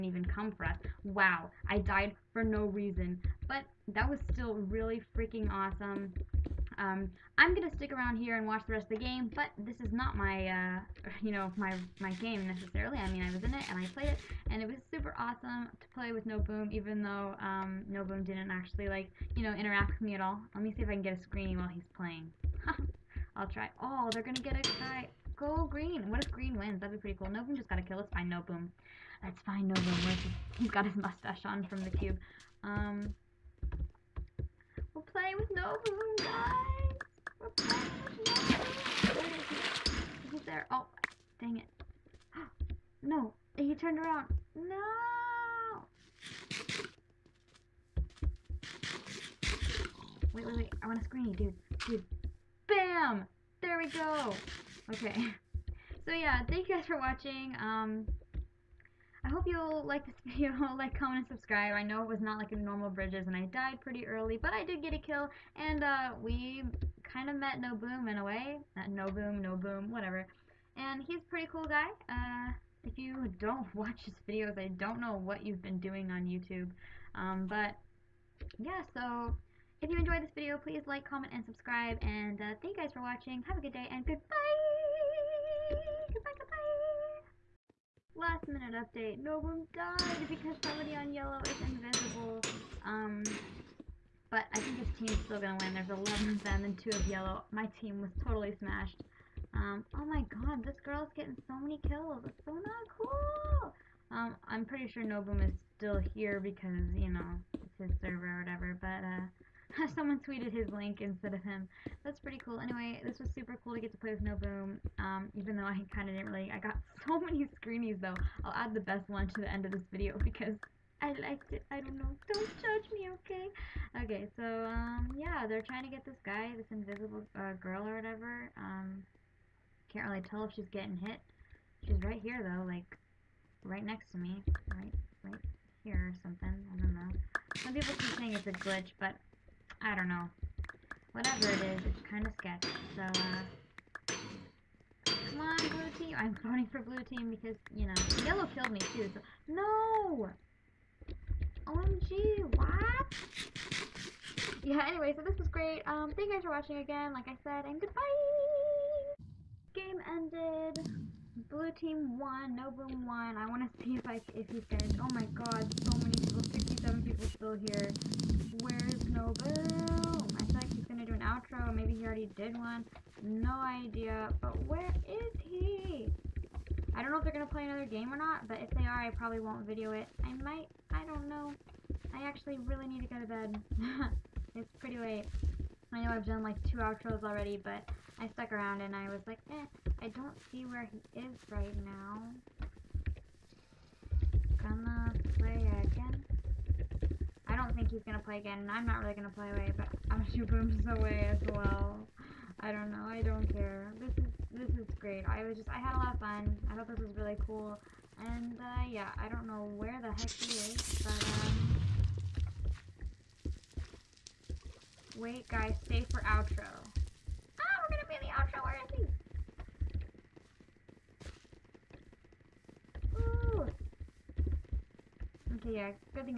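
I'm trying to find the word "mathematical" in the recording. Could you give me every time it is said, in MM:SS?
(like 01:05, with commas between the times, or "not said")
not said.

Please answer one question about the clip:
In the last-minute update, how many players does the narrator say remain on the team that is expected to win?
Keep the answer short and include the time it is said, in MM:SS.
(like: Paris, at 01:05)
11, at 01:35.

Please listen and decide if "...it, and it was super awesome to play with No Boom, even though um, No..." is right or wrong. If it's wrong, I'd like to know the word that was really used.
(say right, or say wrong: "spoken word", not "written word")
right.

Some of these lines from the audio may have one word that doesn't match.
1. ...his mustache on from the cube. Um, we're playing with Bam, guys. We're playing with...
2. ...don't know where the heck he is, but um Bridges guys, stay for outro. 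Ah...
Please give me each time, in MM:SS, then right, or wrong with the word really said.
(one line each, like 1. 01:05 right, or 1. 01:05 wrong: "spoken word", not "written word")
1. 00:30 wrong: "NoBoom", not "Bam"
2. 03:29 wrong: "Wait", not "Bridges".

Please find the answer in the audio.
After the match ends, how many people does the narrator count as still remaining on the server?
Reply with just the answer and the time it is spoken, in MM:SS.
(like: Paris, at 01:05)
67, at 02:46.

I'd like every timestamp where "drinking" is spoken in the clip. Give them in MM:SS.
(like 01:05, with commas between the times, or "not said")
not said.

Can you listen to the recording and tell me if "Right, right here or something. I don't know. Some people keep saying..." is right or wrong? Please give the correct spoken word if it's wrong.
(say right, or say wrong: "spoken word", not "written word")
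right.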